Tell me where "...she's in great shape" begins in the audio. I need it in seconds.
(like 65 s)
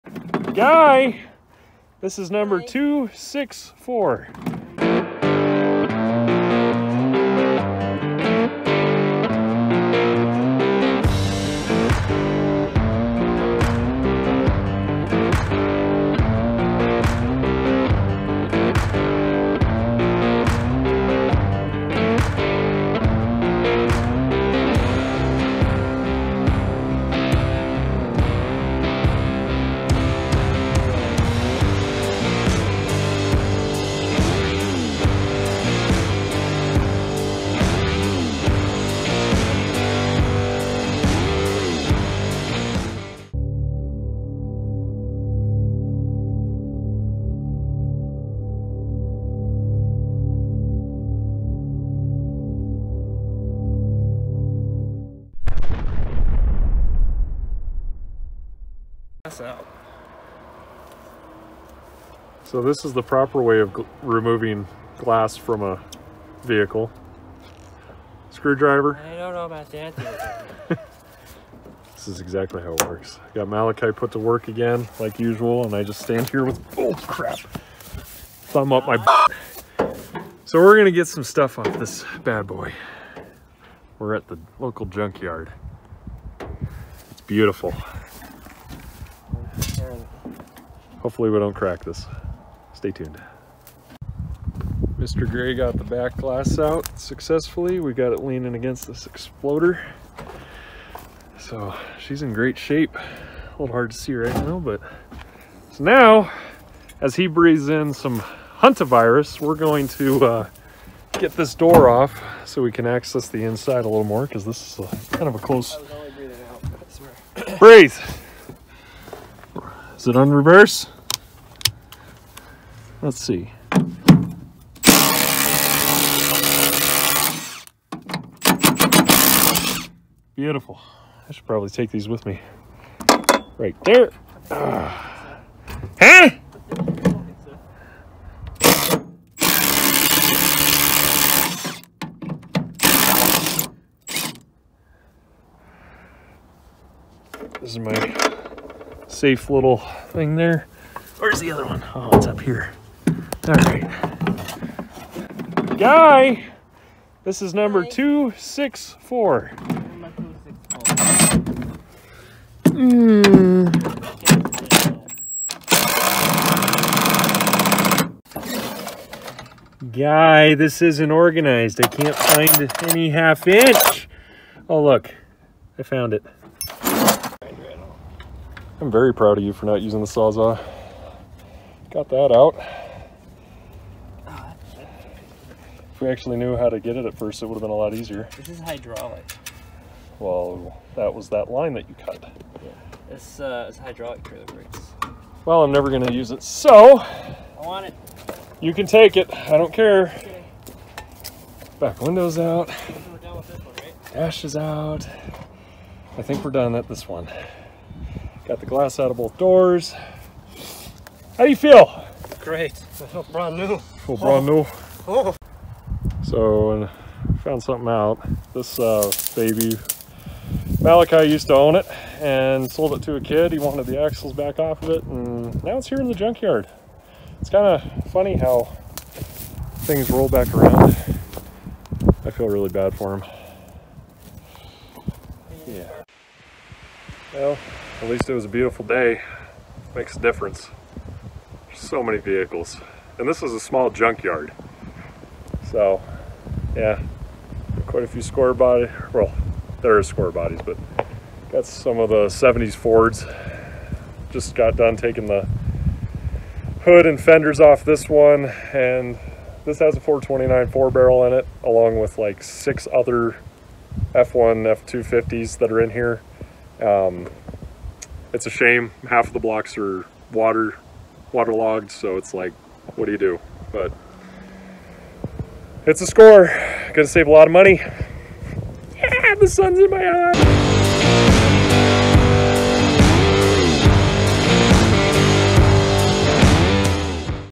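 101 s.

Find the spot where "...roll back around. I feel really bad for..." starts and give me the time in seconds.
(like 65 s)
230 s.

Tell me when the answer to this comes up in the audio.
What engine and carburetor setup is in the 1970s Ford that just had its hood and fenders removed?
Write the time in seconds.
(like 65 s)
259 s.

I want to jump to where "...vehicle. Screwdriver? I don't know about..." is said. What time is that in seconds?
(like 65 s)
66 s.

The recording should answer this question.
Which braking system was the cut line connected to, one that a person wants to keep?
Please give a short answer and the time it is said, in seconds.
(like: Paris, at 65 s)
hydraulic trailer brakes, at 193 s.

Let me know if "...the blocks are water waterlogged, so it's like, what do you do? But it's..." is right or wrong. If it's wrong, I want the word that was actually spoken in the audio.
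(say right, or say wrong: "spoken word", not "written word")
right.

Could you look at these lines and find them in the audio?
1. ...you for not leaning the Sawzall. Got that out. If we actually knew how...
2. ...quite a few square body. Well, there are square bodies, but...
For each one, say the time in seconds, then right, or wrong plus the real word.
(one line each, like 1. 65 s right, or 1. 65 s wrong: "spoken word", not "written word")
1. 179 s wrong: "using", not "leaning"
2. 247 s right.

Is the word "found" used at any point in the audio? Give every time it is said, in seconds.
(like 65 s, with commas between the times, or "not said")
175 s, 217 s.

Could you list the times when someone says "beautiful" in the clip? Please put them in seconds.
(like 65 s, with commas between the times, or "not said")
87 s, 130 s, 238 s.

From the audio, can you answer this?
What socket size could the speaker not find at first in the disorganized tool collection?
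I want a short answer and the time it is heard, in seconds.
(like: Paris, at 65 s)
half inch, at 173 s.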